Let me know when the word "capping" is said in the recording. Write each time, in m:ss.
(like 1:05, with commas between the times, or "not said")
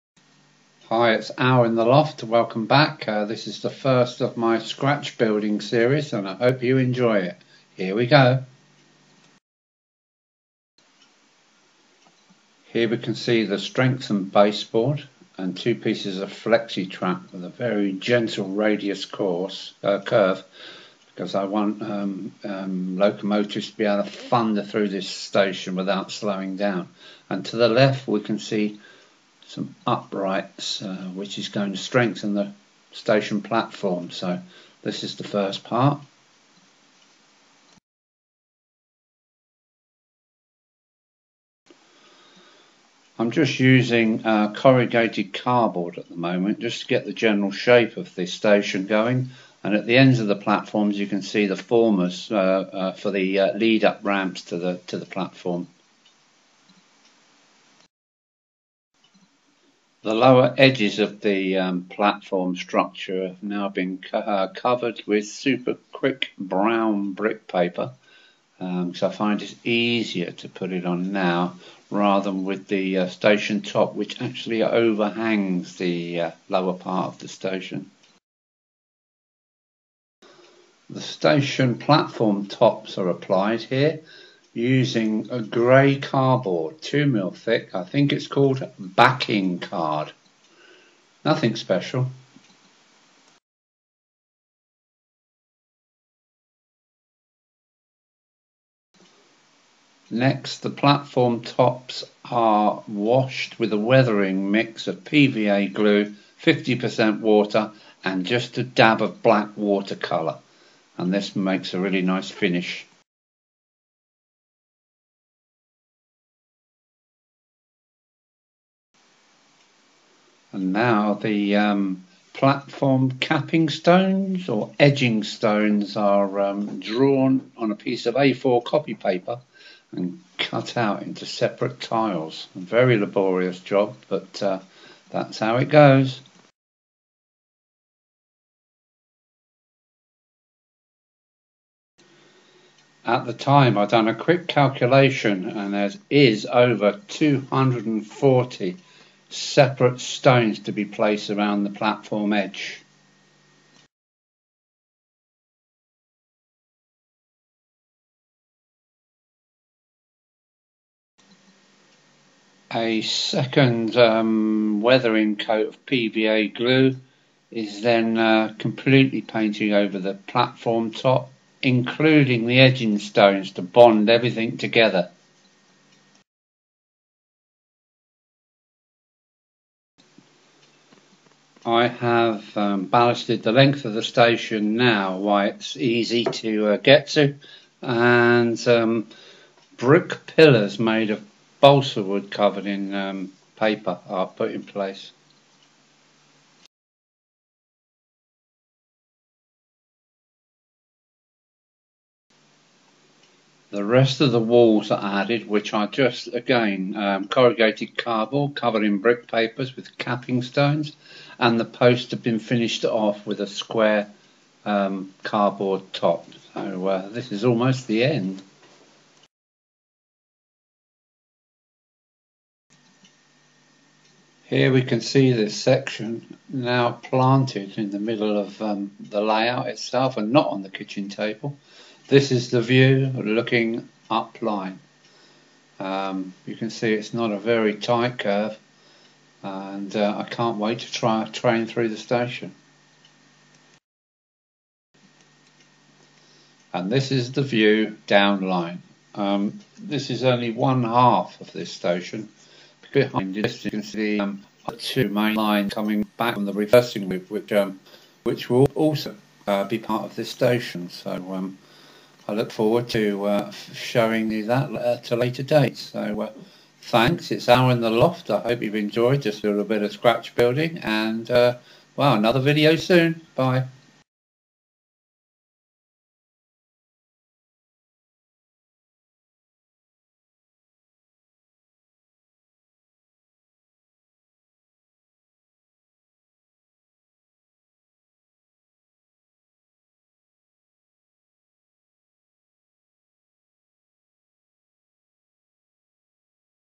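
2:03, 3:29.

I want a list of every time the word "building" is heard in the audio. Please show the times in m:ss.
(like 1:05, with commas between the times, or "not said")
0:05, 4:30.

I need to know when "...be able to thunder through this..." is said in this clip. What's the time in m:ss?
0:23.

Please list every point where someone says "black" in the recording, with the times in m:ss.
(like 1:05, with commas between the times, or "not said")
1:49.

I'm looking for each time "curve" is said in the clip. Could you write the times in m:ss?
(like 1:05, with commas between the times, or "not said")
0:20, 3:58.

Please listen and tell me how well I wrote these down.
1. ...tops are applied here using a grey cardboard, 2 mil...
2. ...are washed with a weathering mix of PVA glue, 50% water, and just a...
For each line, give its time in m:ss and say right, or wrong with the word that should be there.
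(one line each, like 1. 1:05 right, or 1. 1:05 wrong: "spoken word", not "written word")
1. 1:22 right
2. 1:42 right.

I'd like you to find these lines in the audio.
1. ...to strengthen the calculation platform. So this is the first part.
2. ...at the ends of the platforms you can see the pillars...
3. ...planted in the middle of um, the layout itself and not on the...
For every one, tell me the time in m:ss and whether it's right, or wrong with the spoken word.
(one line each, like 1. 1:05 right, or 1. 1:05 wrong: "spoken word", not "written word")
1. 0:31 wrong: "station", not "calculation"
2. 0:49 wrong: "formers", not "pillars"
3. 3:46 right.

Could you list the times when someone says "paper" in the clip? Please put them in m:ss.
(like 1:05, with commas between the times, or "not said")
1:07, 2:08, 3:13, 3:29.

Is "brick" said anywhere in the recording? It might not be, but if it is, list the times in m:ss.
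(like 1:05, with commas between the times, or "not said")
1:07, 3:09, 3:28.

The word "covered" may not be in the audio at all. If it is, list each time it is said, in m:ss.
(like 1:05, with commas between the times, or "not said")
1:04, 3:12, 3:28.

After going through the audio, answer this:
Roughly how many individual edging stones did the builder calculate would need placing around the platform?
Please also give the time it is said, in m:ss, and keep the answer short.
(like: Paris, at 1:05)
Over 240, at 2:26.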